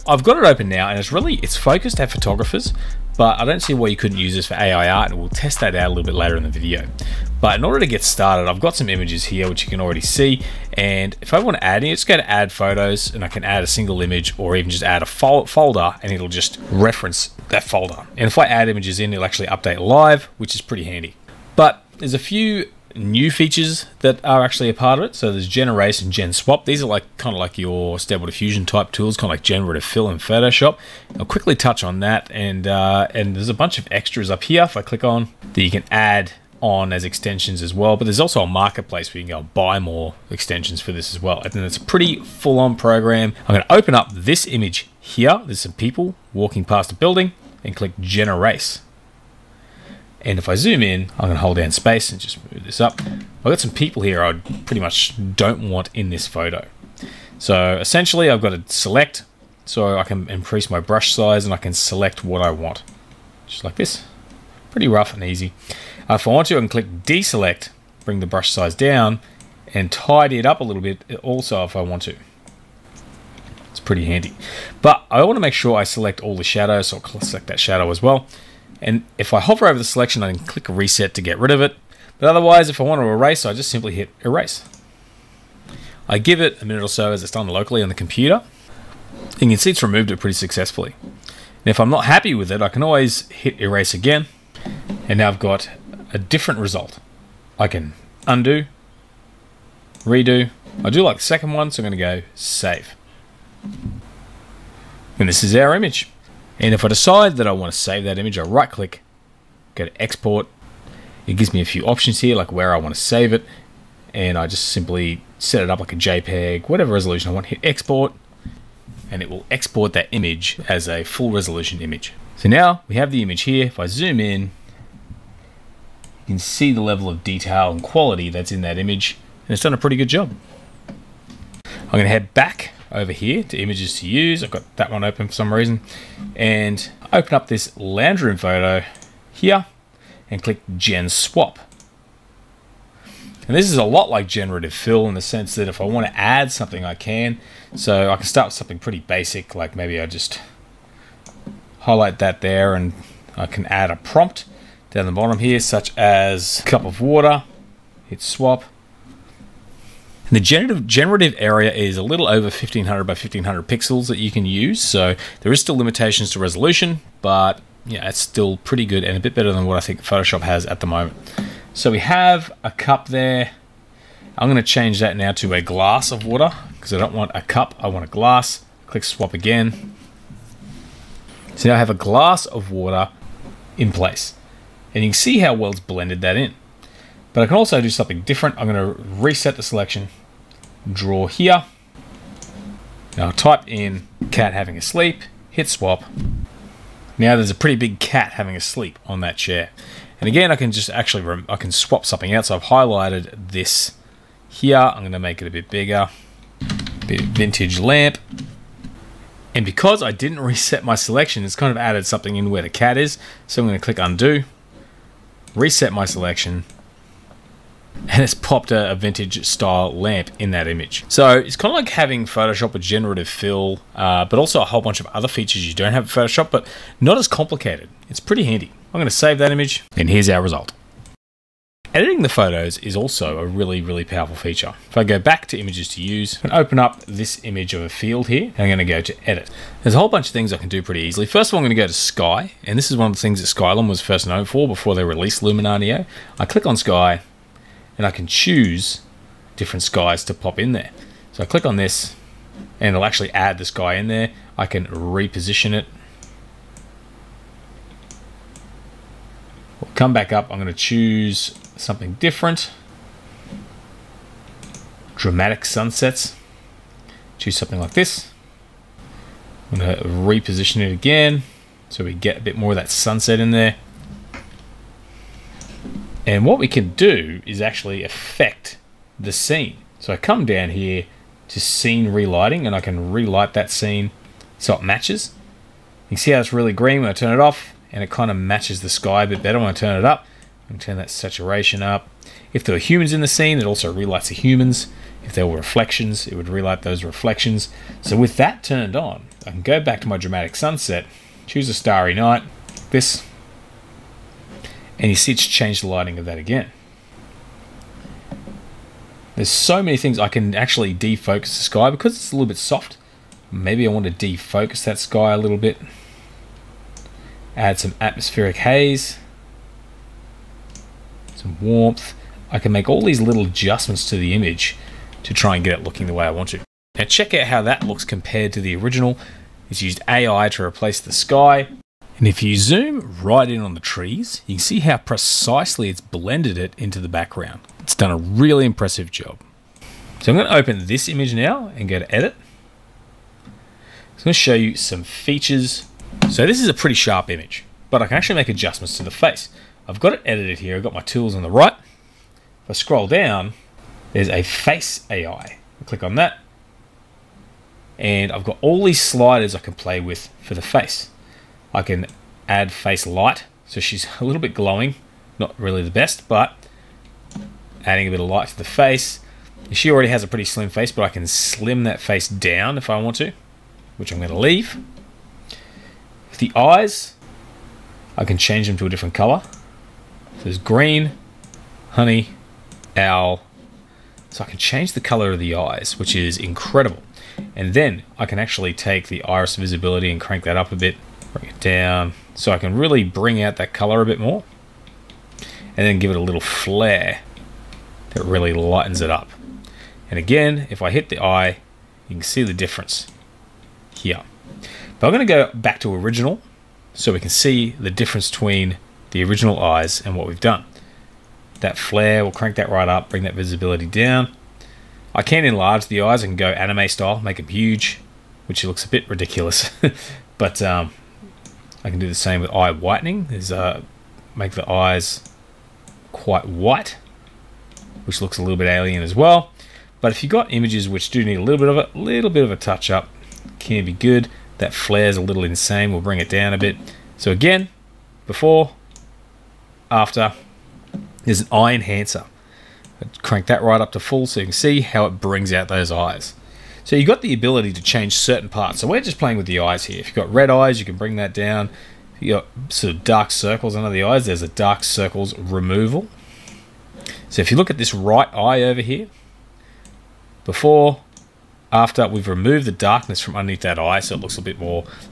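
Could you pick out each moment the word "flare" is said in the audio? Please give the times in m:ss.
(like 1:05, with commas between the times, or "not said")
6:36, 6:51, 7:14.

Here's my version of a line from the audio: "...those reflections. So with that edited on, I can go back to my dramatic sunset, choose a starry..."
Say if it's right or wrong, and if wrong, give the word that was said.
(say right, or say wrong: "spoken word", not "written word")
wrong: "turned", not "edited".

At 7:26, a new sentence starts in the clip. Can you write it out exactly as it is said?
So you've got the ability to change certain parts.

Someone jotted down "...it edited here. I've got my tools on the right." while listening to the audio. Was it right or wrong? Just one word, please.
right.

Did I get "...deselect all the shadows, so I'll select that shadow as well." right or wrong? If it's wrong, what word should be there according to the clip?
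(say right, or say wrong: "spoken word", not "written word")
wrong: "select", not "deselect".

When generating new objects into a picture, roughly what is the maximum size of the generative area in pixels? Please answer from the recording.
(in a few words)
1500 by 1500 pixels.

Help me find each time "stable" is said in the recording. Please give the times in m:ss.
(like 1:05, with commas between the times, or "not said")
0:27.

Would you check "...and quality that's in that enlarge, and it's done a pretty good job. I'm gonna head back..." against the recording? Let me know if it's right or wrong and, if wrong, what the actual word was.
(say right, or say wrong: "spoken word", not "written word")
wrong: "image", not "enlarge".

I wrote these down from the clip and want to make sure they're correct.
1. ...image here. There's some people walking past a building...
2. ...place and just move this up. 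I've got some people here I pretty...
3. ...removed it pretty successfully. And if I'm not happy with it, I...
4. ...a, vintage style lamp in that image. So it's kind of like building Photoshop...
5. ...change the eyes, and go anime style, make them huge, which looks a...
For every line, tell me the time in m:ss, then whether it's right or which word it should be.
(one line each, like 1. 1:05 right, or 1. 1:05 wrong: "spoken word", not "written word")
1. 0:44 right
2. 0:51 wrong: "space", not "place"
3. 1:29 right
4. 3:38 wrong: "having", not "building"
5. 6:55 wrong: "enlarge", not "change".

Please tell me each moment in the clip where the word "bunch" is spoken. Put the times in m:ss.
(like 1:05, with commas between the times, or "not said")
0:33, 3:44, 4:00.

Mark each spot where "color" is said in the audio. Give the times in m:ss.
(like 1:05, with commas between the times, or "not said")
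6:19, 6:25, 6:33.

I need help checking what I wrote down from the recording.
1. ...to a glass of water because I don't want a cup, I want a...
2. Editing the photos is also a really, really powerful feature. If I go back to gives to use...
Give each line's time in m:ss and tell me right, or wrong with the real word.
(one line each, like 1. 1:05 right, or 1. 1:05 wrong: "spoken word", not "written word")
1. 2:55 right
2. 3:51 wrong: "images", not "gives".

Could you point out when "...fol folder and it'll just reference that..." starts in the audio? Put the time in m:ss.
0:15.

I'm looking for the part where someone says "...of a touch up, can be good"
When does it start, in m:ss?
7:12.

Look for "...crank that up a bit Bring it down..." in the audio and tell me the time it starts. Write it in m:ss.
6:30.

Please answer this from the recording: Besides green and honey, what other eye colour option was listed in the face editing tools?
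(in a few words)
owl.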